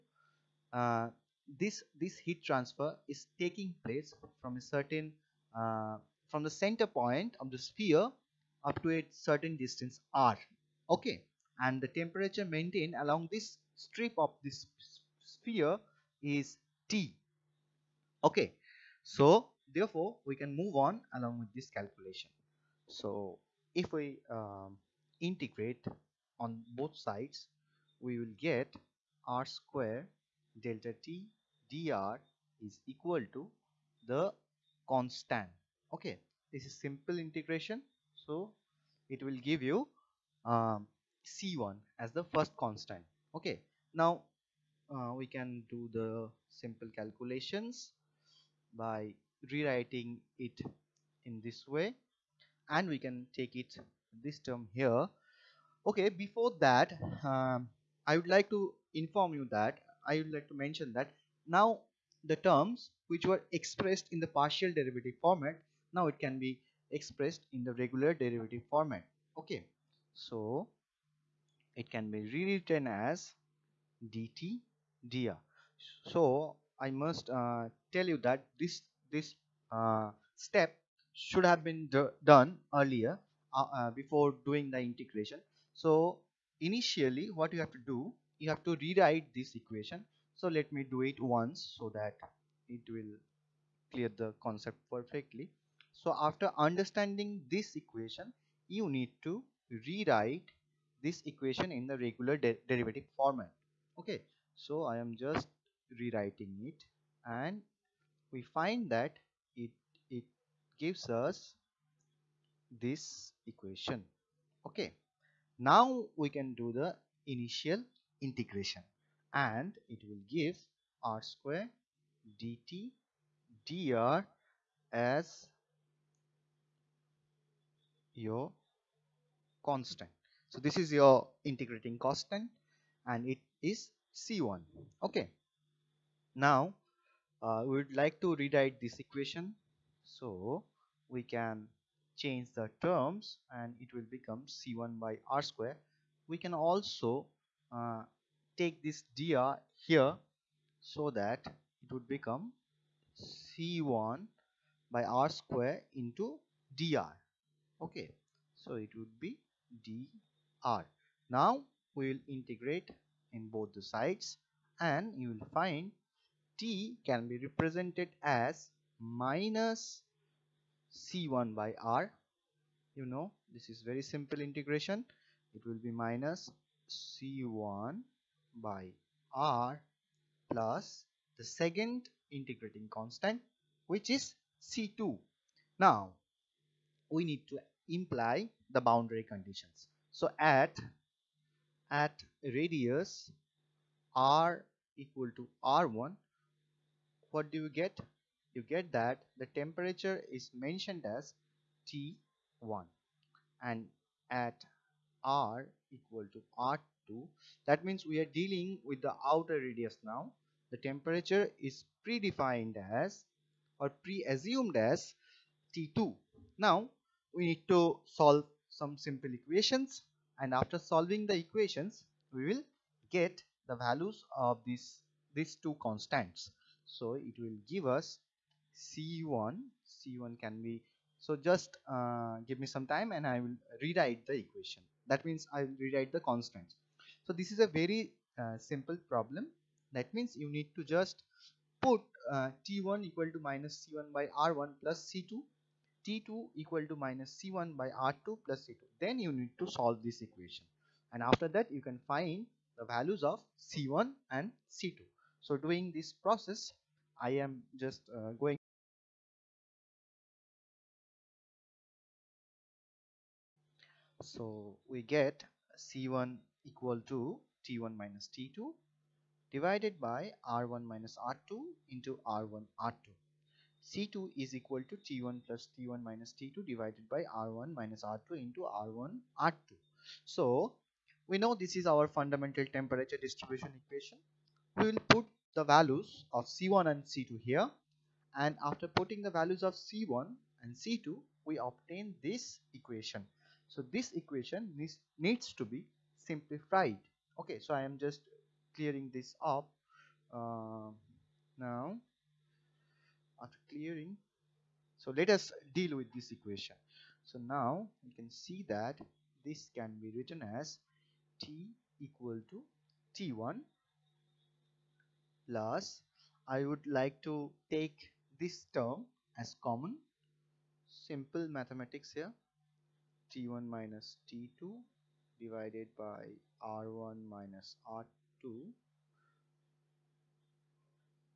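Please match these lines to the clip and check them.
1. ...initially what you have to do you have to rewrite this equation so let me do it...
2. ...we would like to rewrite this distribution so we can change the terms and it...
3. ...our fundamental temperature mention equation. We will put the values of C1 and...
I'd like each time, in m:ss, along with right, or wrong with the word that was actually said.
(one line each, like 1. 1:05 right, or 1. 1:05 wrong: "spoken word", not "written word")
1. 1:26 right
2. 2:17 wrong: "equation", not "distribution"
3. 4:41 wrong: "distribution", not "mention".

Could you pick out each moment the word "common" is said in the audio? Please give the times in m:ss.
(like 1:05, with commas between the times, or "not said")
5:19.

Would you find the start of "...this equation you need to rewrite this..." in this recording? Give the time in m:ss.
1:37.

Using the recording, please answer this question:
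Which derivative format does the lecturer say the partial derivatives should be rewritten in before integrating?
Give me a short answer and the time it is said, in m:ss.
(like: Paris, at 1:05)
regular derivative format, at 1:07.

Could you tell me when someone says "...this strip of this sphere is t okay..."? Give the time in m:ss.
0:13.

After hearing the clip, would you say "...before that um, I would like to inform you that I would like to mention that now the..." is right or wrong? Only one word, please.
right.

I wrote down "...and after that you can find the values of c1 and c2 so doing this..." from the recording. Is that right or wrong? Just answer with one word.
right.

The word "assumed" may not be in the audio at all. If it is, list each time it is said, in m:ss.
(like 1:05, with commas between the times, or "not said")
3:33.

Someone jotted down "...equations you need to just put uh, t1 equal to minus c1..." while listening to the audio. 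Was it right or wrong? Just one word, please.
wrong.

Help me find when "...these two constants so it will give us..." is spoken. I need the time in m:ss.
3:45.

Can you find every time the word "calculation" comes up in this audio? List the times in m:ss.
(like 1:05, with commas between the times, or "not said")
0:21, 0:46.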